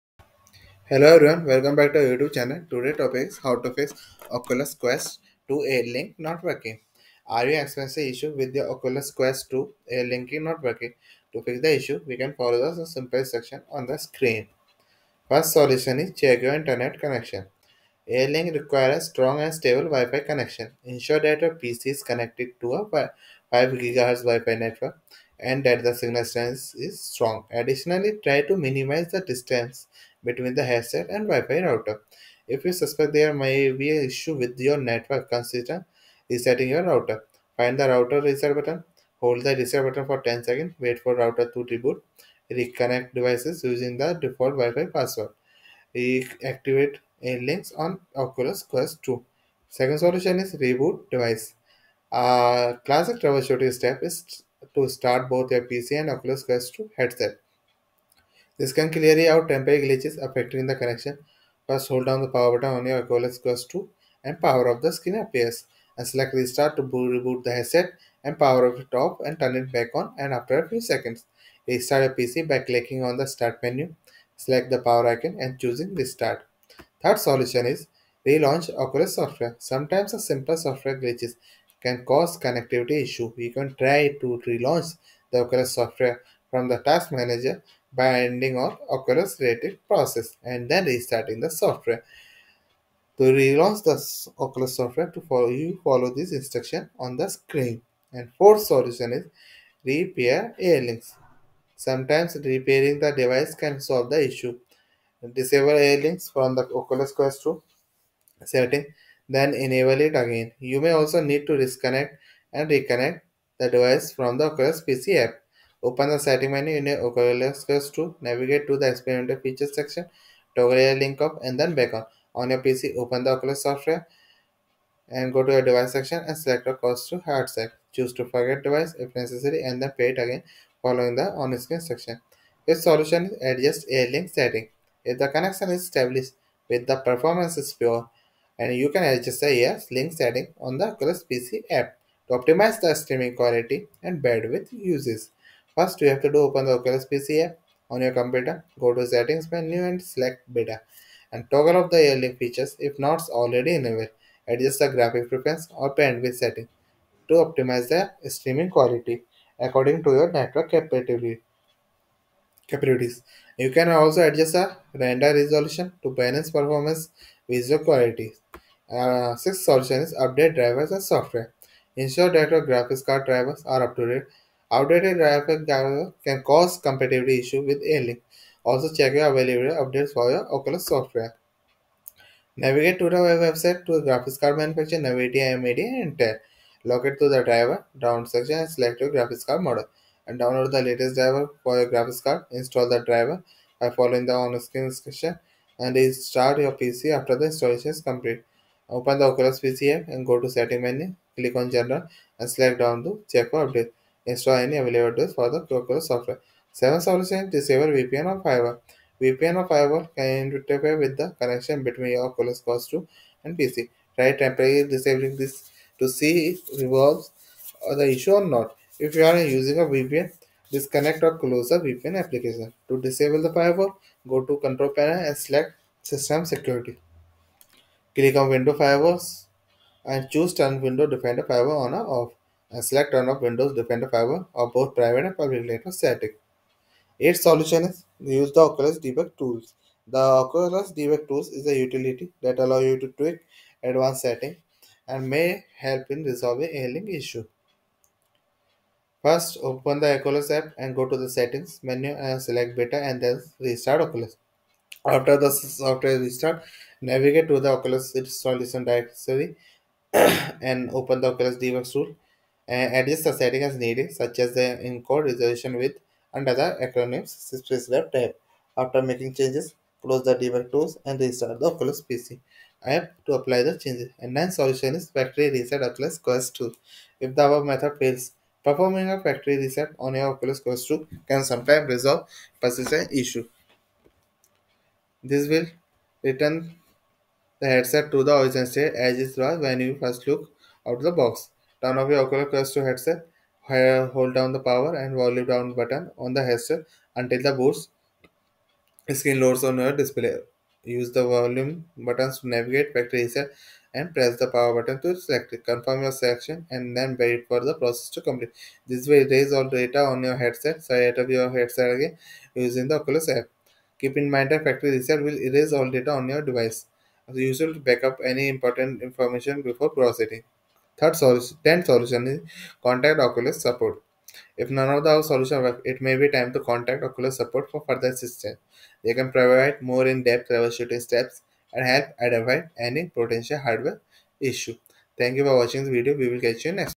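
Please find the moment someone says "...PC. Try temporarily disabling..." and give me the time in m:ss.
3:33.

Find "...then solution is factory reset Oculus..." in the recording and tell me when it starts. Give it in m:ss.
4:34.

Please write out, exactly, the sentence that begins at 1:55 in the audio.
Open the setting menu in your Quest to navigate to the experimental features section, toggle your link up and then back on.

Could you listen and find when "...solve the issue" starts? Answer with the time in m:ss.
1:43.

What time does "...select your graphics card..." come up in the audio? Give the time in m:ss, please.
3:08.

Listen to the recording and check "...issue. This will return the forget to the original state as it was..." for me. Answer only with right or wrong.
wrong.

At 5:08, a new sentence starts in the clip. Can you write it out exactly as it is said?
This way, raise all data on your headset, set up your headset again using the Oculus app.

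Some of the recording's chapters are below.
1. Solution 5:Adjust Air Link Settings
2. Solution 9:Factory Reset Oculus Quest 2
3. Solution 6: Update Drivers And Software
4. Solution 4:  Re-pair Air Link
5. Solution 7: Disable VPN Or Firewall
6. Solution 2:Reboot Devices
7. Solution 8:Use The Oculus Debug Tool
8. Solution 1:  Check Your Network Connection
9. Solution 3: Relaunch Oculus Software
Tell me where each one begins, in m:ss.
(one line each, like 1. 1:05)
1. 2:14
2. 4:35
3. 2:50
4. 1:39
5. 3:27
6. 0:50
7. 3:57
8. 0:16
9. 1:17.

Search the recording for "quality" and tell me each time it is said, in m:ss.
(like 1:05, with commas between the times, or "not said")
2:23, 2:38, 2:47.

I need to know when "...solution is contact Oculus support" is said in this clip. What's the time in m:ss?
5:21.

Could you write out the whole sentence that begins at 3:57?
Its solution is use the Oculus debug tools.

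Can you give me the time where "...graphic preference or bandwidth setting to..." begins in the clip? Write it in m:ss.
2:34.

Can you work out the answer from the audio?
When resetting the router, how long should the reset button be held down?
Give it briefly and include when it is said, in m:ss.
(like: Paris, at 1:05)
10 seconds, at 0:40.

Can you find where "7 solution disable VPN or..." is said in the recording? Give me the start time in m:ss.
3:26.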